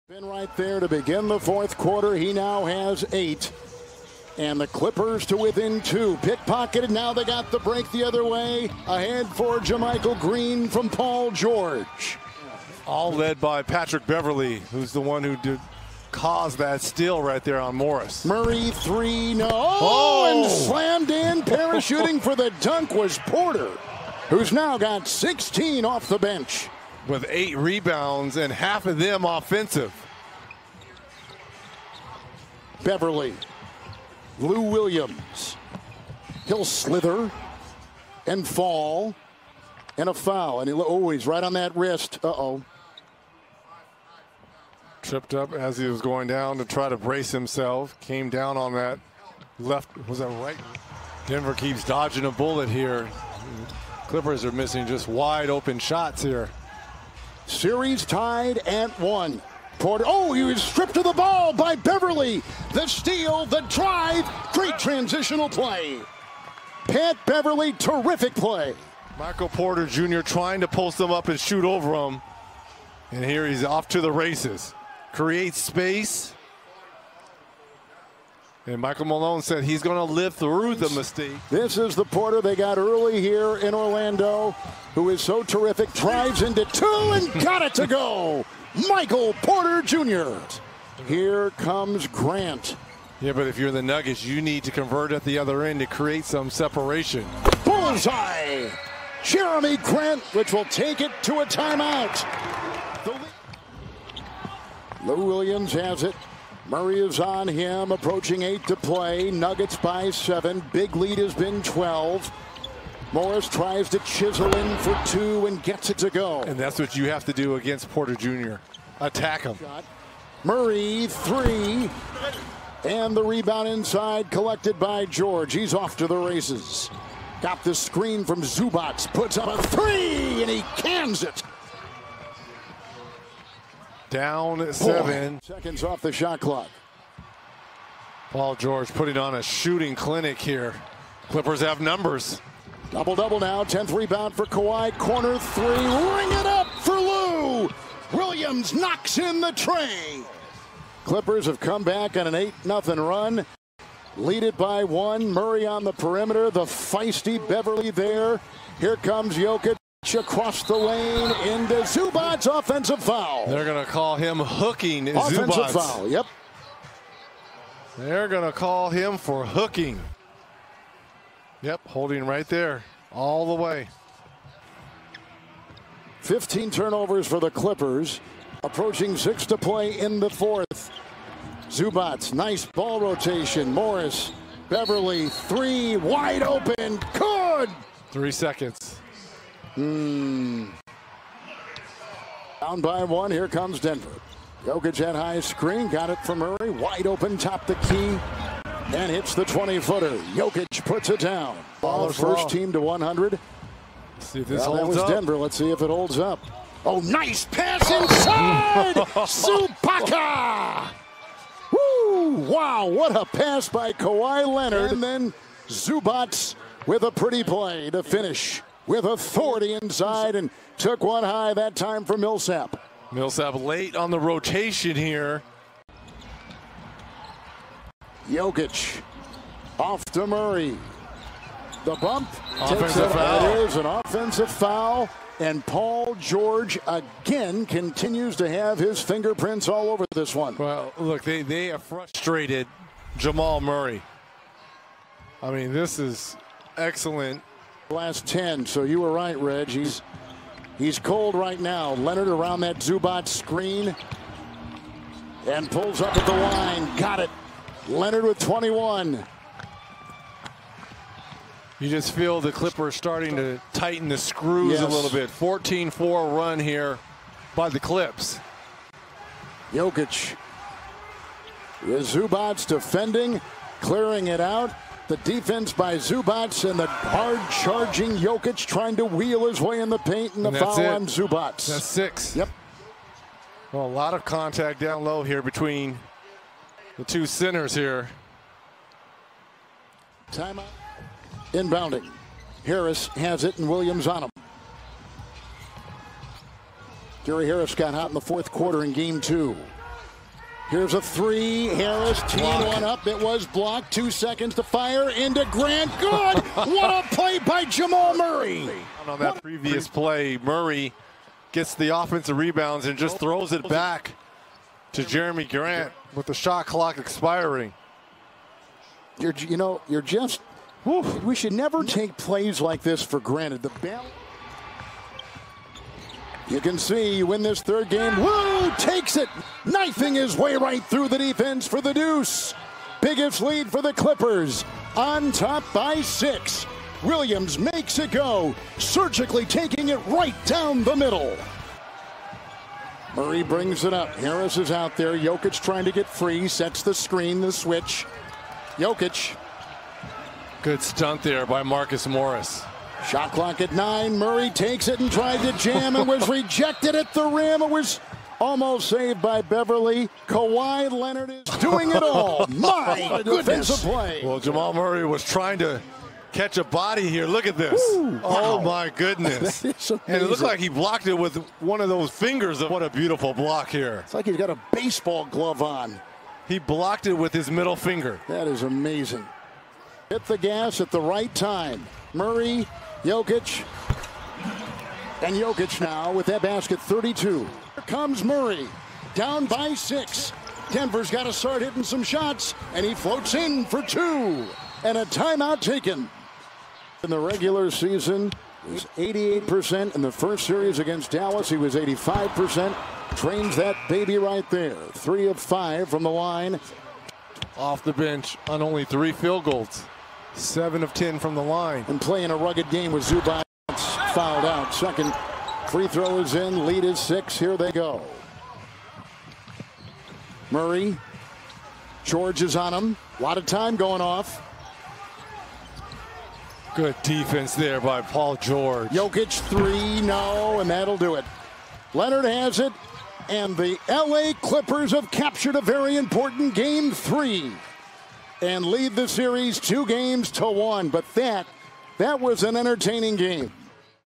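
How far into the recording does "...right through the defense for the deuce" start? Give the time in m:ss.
5:30.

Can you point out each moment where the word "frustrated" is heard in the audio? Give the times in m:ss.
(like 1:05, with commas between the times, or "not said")
4:01.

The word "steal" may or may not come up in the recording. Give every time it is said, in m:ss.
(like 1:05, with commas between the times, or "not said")
0:16, 1:02.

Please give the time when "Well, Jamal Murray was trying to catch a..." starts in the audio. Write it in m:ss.
6:04.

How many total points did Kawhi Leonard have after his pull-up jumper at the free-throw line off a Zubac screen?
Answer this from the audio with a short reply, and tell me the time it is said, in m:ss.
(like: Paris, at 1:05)
21, at 4:18.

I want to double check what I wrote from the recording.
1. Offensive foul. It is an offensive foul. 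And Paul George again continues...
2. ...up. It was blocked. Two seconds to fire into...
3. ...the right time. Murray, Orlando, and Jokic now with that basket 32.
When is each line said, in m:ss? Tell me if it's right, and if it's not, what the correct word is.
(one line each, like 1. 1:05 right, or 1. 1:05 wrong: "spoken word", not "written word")
1. 3:52 right
2. 5:02 right
3. 6:20 wrong: "Jokic", not "Orlando".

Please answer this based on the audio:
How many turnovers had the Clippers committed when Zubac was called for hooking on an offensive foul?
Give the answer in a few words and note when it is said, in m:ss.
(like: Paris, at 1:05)
15, at 2:56.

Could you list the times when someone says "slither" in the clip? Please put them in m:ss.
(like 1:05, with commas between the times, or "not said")
0:36.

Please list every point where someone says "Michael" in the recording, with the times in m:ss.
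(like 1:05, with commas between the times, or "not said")
1:09, 1:18, 1:28.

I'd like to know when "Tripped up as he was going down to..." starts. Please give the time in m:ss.
0:45.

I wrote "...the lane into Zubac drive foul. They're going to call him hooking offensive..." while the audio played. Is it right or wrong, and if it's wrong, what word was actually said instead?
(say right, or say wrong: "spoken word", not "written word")
wrong: "offensive", not "drive".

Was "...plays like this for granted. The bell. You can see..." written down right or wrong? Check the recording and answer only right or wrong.
right.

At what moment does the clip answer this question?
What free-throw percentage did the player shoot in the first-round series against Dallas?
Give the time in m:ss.
6:41.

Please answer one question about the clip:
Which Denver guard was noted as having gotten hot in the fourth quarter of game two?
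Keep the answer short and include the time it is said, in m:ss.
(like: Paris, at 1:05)
Gary Harris, at 4:57.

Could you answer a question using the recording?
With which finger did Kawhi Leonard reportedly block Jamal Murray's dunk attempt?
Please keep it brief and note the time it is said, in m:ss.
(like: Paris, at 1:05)
middle finger, at 6:17.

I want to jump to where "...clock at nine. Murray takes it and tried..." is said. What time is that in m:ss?
5:53.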